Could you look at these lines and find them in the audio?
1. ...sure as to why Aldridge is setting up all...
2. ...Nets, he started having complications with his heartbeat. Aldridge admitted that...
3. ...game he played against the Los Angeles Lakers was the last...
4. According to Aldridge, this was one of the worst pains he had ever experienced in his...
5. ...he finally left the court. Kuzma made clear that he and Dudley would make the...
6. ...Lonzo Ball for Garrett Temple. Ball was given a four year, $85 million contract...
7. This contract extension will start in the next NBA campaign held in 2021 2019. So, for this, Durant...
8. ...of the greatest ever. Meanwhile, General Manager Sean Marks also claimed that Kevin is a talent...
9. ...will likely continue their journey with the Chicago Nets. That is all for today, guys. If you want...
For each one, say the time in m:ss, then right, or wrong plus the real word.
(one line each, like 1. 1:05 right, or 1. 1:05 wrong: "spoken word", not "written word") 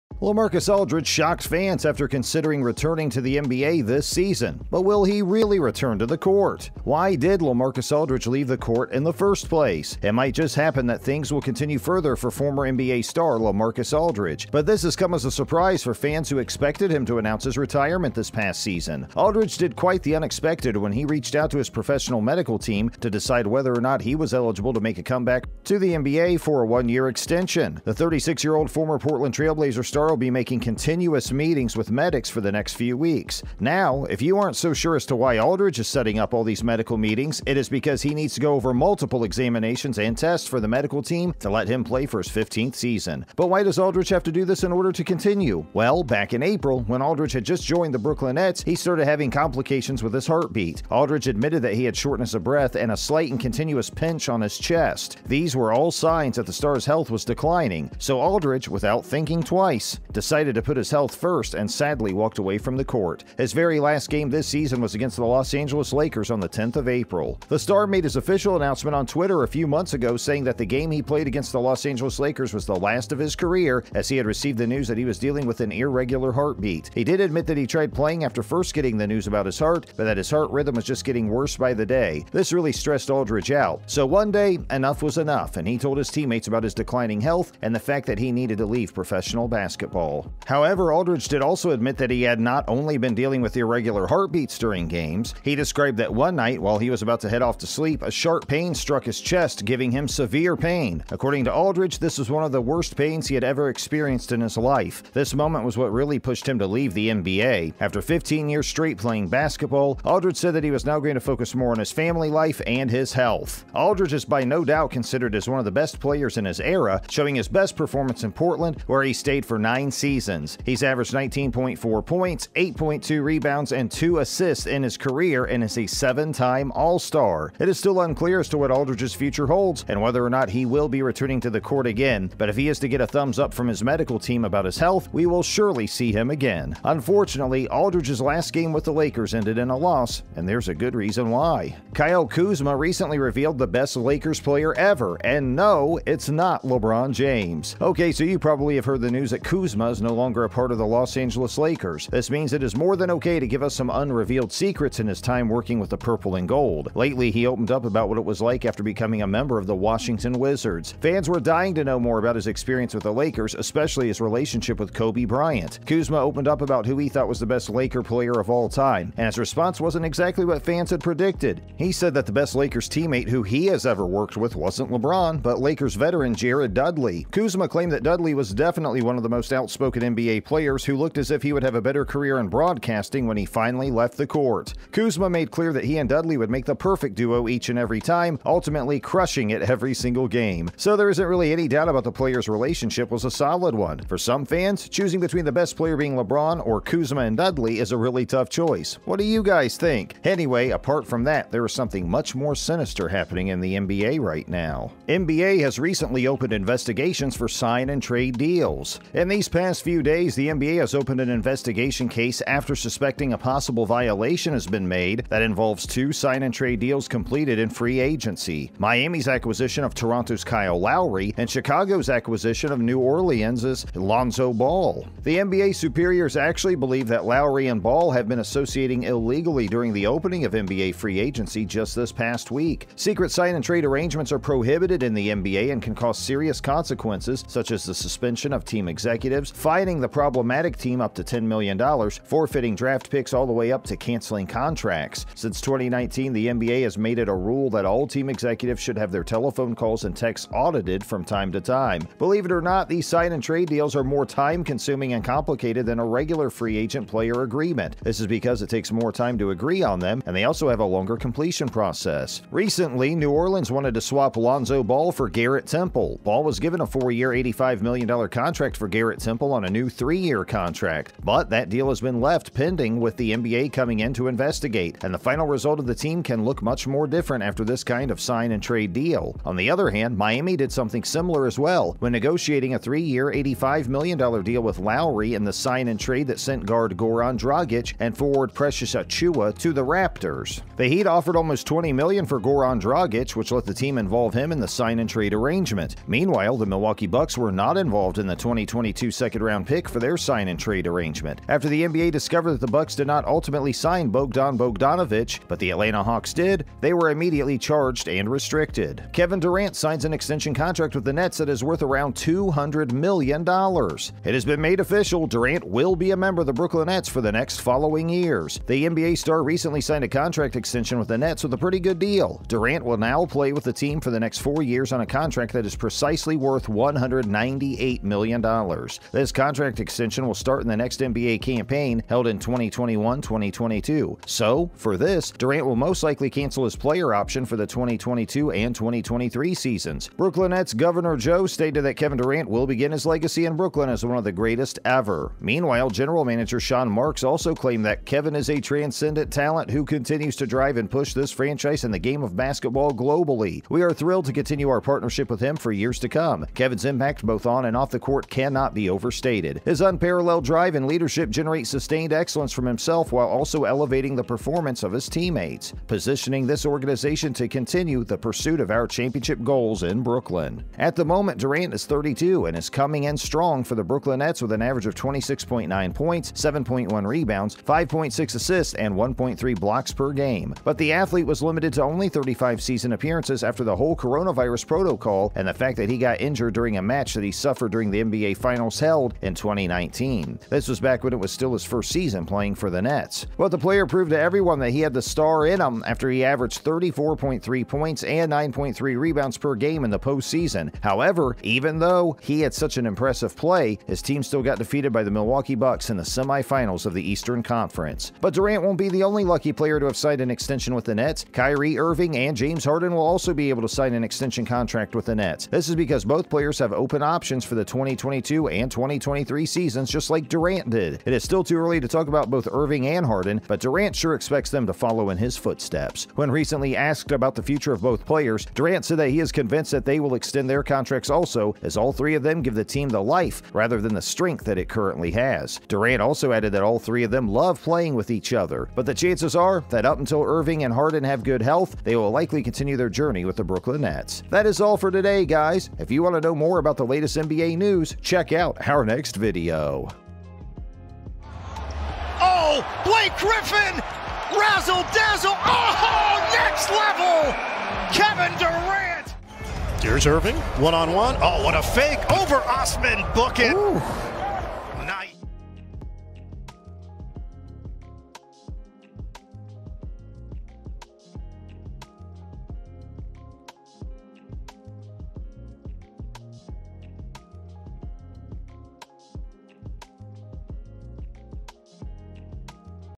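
1. 0:34 right
2. 0:48 right
3. 1:10 right
4. 1:41 right
5. 3:03 right
6. 4:24 right
7. 5:29 wrong: "2022", not "2019"
8. 5:44 wrong: "transcendent", not "talent"
9. 7:21 wrong: "Brooklyn", not "Chicago".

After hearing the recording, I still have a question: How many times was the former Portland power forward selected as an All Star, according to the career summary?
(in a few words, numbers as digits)
7.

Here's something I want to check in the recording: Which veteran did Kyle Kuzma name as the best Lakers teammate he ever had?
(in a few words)
Jared Dudley.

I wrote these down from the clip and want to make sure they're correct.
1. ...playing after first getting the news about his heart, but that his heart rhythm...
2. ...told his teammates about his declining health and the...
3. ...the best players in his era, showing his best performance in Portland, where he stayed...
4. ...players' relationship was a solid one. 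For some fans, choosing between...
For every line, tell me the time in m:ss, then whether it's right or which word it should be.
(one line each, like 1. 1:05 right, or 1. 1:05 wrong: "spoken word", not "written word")
1. 1:17 right
2. 1:25 right
3. 1:55 right
4. 3:12 right.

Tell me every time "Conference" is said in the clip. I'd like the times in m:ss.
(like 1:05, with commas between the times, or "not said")
6:47.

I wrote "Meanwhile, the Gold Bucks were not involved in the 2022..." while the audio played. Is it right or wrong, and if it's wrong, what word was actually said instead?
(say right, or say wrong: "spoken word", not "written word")
wrong: "Milwaukee", not "Gold".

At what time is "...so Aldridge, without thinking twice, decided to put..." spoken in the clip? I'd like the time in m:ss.
0:57.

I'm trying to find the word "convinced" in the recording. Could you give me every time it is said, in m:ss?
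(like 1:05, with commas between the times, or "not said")
7:09.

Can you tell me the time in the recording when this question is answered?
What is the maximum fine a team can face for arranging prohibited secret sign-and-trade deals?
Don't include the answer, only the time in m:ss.
4:01.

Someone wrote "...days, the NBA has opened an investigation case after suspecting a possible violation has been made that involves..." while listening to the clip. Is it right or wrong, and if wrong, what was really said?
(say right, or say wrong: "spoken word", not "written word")
right.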